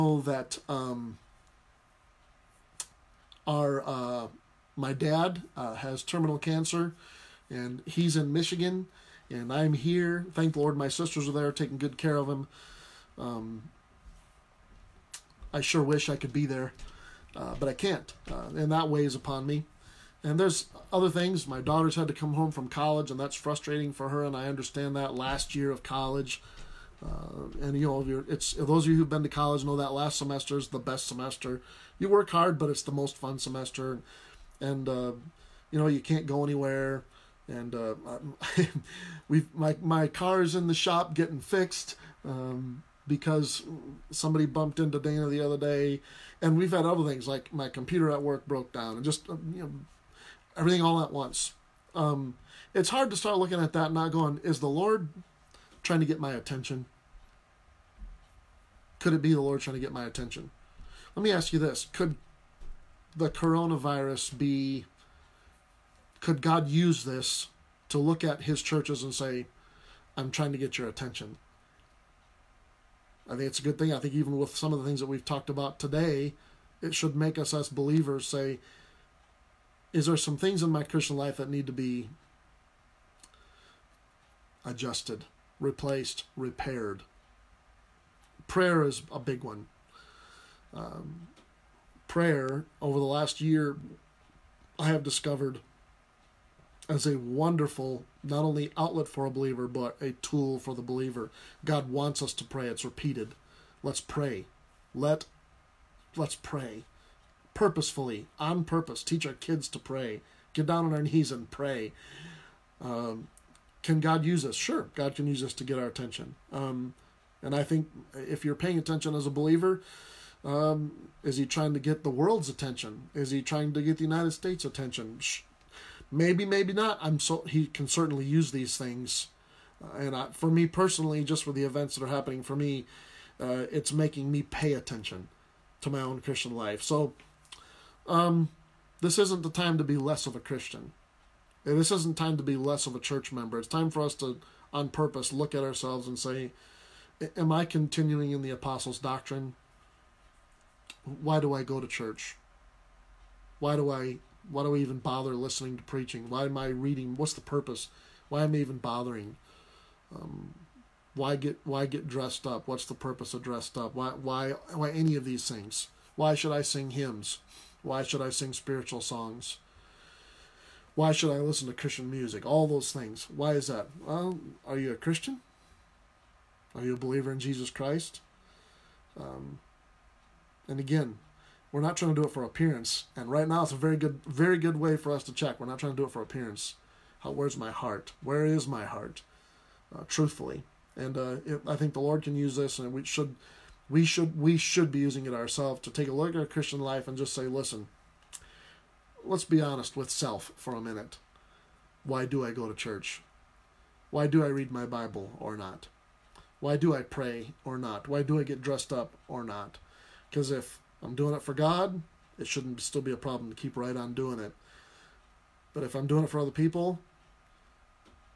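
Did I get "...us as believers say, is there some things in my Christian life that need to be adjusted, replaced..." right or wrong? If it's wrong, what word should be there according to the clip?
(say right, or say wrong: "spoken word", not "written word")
right.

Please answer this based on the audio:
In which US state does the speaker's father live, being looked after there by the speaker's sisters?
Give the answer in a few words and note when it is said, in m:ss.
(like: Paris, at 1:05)
Michigan, at 0:08.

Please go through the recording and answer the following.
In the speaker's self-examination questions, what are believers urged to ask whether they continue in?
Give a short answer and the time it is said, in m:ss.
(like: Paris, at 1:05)
The apostles' doctrine, at 2:28.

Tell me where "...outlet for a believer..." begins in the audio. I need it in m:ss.
1:38.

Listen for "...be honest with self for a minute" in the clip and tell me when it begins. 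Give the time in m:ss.
3:19.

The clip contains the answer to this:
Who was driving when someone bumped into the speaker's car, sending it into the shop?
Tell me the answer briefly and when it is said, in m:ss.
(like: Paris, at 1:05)
Dana, at 0:44.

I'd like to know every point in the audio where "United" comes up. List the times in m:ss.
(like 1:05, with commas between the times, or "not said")
2:04.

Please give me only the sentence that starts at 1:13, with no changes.
I think it's a good thing.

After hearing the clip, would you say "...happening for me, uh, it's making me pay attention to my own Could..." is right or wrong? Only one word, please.
wrong.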